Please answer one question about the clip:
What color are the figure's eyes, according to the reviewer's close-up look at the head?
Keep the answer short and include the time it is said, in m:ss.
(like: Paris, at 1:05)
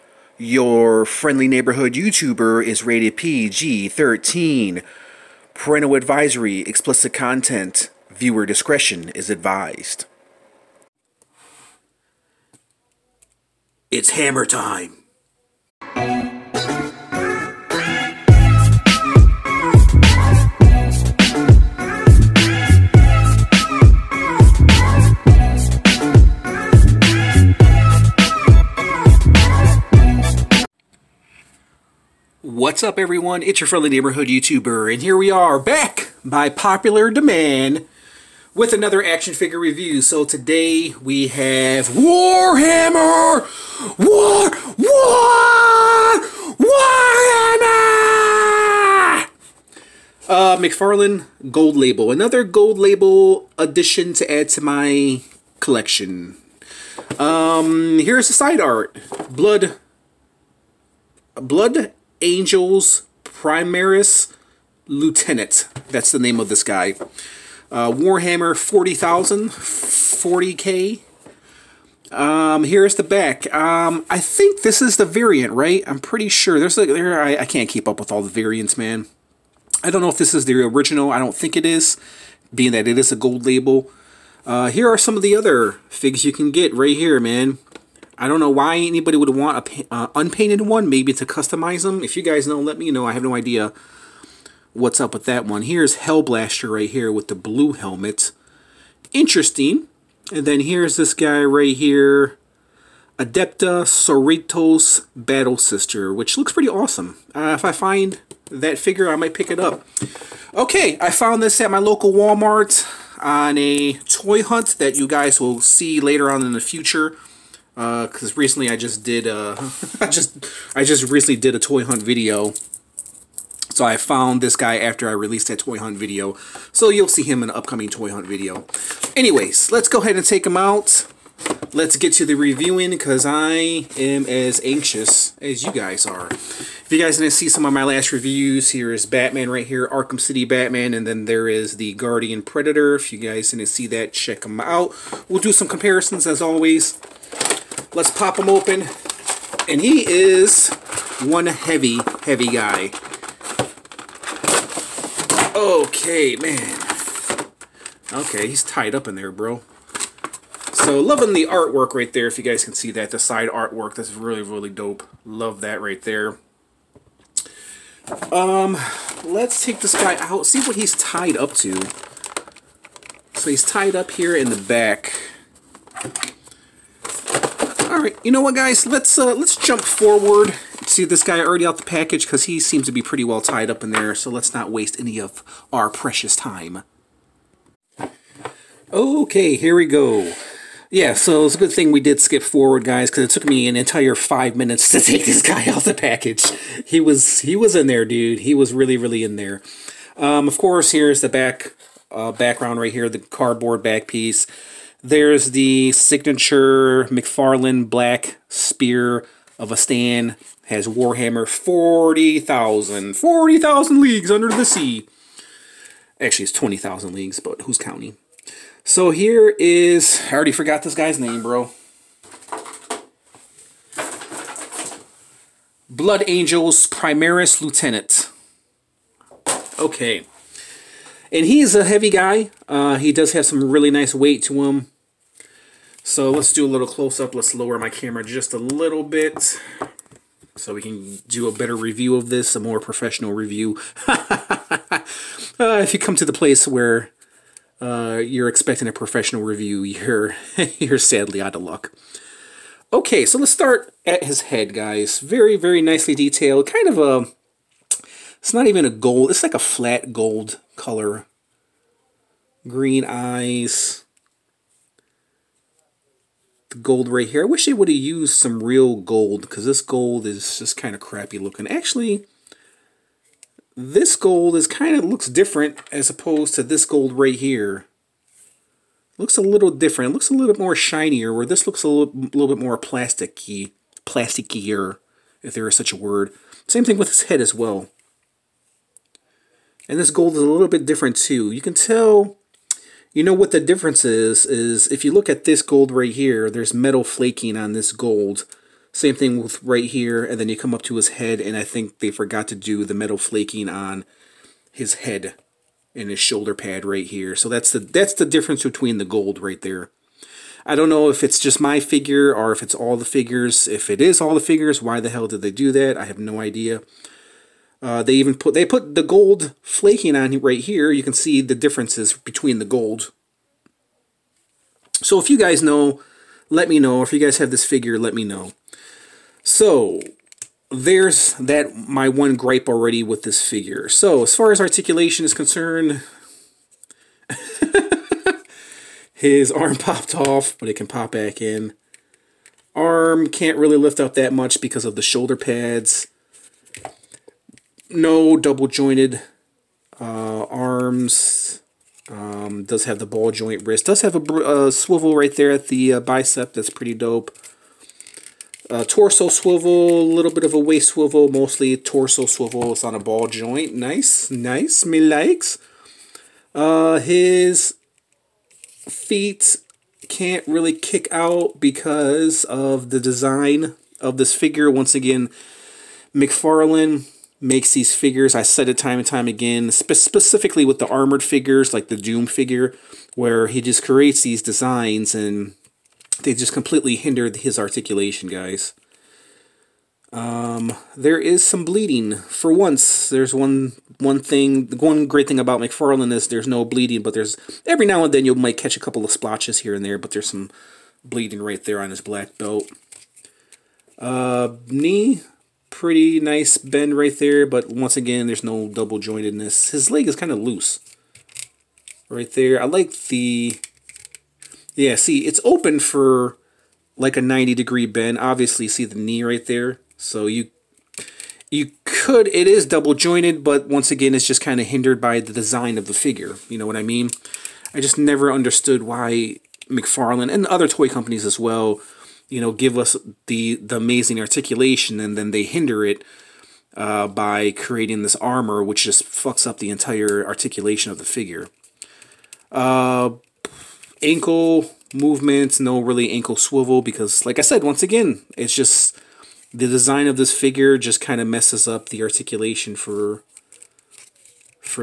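Green, at 4:22.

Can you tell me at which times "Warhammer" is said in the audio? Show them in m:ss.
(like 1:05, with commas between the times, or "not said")
0:41, 0:46, 1:07, 3:30.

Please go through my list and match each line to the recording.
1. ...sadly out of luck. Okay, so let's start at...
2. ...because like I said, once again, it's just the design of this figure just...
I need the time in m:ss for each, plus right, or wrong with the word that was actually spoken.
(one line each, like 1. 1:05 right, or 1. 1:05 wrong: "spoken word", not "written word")
1. 4:10 right
2. 7:26 right.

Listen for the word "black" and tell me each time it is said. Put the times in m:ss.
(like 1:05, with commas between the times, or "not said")
3:27, 6:42.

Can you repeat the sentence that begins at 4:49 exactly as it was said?
And this gold is a little bit different too.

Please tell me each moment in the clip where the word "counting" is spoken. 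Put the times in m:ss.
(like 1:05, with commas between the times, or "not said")
3:37.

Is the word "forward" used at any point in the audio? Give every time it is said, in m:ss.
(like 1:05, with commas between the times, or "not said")
2:59, 3:12.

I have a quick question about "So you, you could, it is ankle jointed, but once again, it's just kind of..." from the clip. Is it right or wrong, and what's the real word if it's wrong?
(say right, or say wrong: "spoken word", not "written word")
wrong: "double", not "ankle".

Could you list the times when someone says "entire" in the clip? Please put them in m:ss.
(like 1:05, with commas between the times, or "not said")
3:13, 7:19.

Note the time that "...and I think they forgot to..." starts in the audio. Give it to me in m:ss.
5:01.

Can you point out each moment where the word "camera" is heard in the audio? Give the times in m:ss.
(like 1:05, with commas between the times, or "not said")
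3:57.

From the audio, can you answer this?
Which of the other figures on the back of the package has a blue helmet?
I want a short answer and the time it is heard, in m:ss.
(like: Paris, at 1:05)
Hellblaster, at 1:35.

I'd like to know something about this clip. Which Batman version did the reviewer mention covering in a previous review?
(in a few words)
Arkham City Batman.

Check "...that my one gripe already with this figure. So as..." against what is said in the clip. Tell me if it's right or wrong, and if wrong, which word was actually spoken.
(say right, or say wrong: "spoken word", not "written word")
right.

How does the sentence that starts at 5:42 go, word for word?
Arm can't really lift up that much because of the shoulder pads no double jointed uh, arms.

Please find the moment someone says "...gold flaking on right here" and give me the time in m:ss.
5:19.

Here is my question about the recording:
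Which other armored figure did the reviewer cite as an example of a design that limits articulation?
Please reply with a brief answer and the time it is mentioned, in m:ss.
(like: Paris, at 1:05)
Doom, at 6:21.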